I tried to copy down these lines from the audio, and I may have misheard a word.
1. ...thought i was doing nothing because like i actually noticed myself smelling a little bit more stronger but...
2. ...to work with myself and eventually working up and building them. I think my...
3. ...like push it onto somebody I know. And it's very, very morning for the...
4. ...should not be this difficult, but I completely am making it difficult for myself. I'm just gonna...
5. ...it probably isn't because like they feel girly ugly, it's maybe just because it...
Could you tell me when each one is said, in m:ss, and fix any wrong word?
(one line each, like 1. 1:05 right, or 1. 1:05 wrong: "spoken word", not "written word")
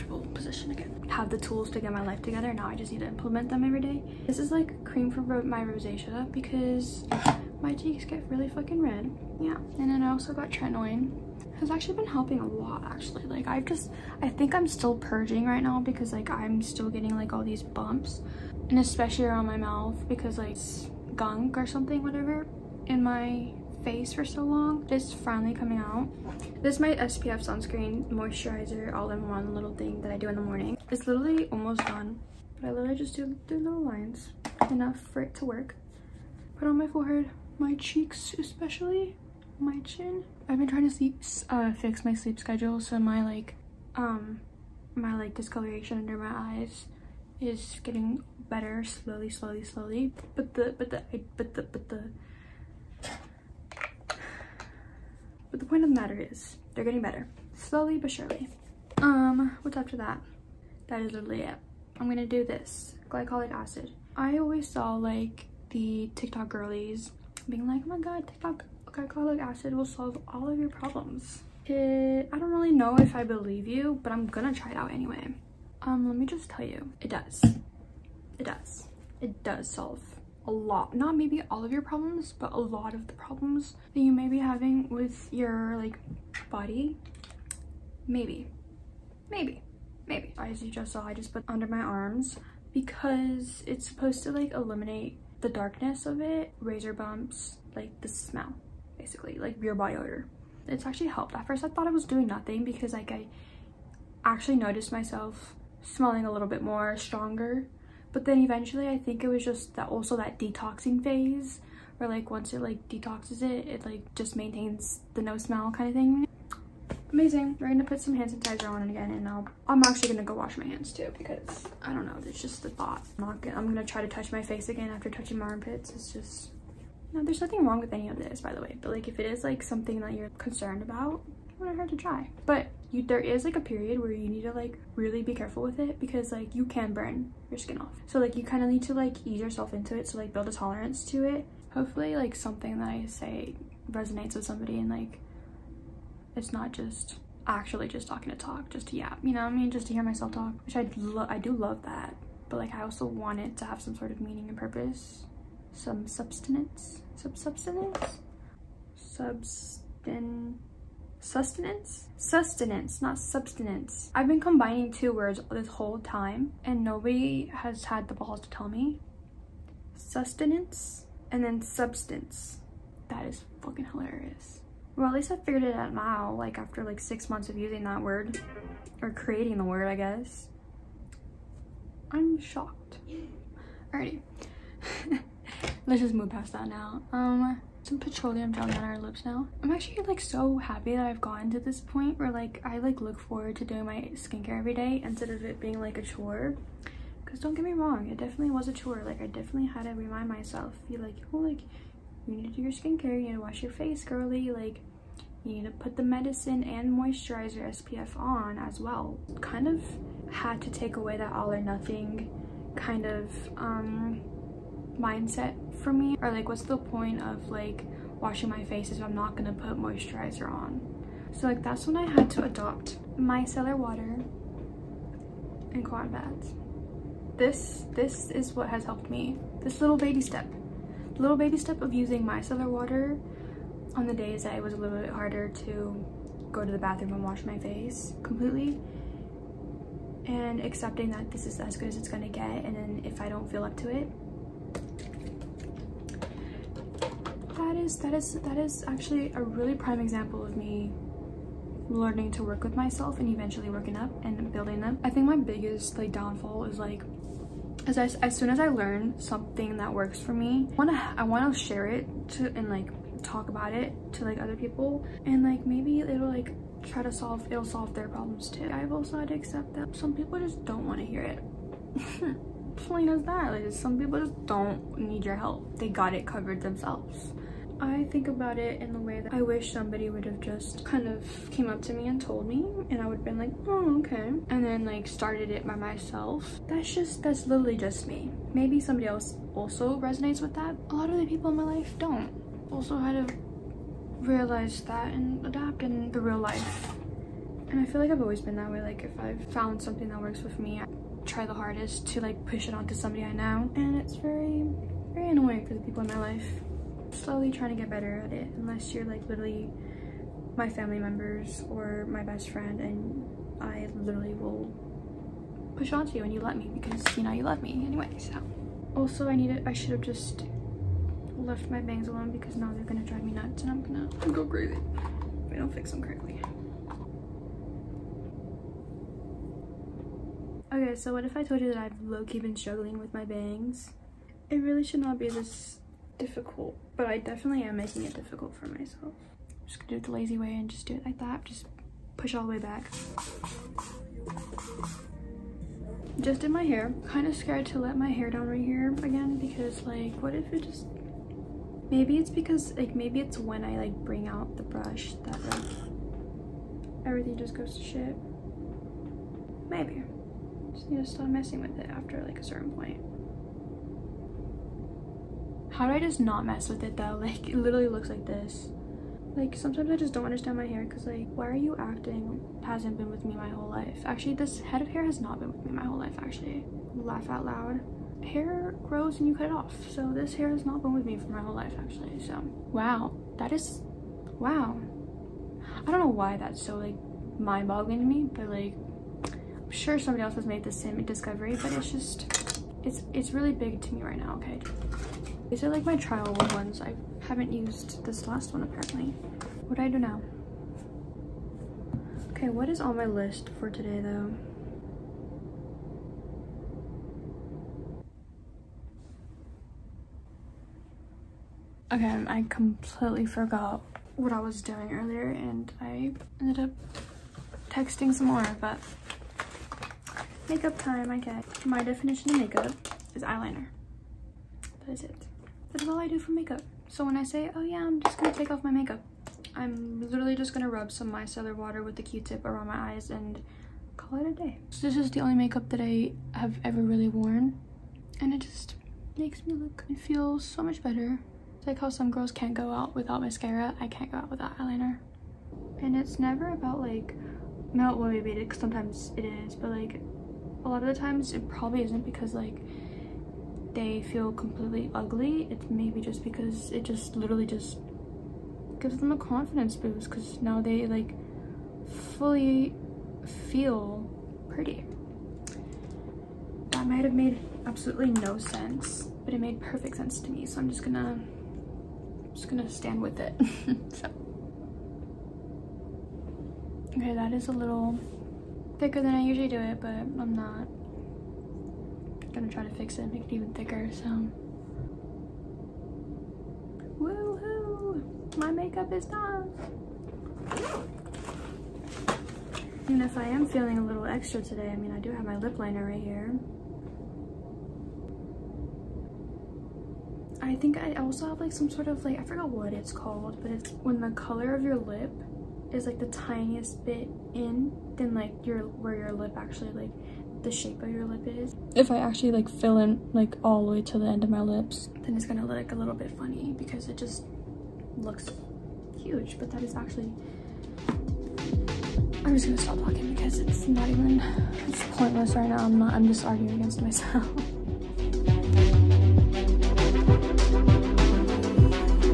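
1. 1:41 right
2. 4:12 right
3. 5:02 wrong: "annoying", not "morning"
4. 5:34 wrong: "definitely", not "completely"
5. 7:31 wrong: "completely", not "girly".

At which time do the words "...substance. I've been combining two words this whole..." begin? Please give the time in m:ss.
2:43.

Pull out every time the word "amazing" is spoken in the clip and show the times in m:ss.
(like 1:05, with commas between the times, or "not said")
1:57.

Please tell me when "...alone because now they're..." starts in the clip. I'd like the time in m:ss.
5:22.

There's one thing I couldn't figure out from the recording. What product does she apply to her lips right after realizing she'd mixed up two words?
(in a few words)
Petroleum.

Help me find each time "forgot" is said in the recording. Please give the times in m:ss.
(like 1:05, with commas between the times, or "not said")
6:53, 8:22.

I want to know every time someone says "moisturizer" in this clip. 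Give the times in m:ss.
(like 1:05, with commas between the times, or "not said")
0:28, 3:26, 3:39.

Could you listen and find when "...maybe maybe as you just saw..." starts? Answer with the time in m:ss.
1:29.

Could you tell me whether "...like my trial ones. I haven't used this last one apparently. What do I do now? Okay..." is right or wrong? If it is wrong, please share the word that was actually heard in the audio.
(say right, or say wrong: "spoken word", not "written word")
right.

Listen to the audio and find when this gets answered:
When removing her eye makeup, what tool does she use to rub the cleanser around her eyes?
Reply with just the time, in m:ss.
7:12.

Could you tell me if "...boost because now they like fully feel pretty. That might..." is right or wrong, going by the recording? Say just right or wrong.
right.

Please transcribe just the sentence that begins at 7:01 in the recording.
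My definition of makeup is eyeliner.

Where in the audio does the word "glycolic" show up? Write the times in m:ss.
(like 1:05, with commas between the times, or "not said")
1:03, 1:08.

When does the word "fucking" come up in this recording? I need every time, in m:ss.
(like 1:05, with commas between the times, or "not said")
0:08, 2:53.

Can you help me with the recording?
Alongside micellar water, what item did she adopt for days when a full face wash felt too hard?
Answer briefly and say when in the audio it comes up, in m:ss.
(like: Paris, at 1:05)
Cotton pads, at 3:45.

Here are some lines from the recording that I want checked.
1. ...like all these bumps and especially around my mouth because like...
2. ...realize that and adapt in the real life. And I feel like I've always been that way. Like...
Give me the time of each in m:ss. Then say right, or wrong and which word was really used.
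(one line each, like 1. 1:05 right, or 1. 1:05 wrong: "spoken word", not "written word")
1. 0:17 right
2. 4:54 right.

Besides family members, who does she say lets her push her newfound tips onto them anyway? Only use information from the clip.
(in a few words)
Best friend.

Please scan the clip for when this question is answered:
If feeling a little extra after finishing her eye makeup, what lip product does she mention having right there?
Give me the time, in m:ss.
8:15.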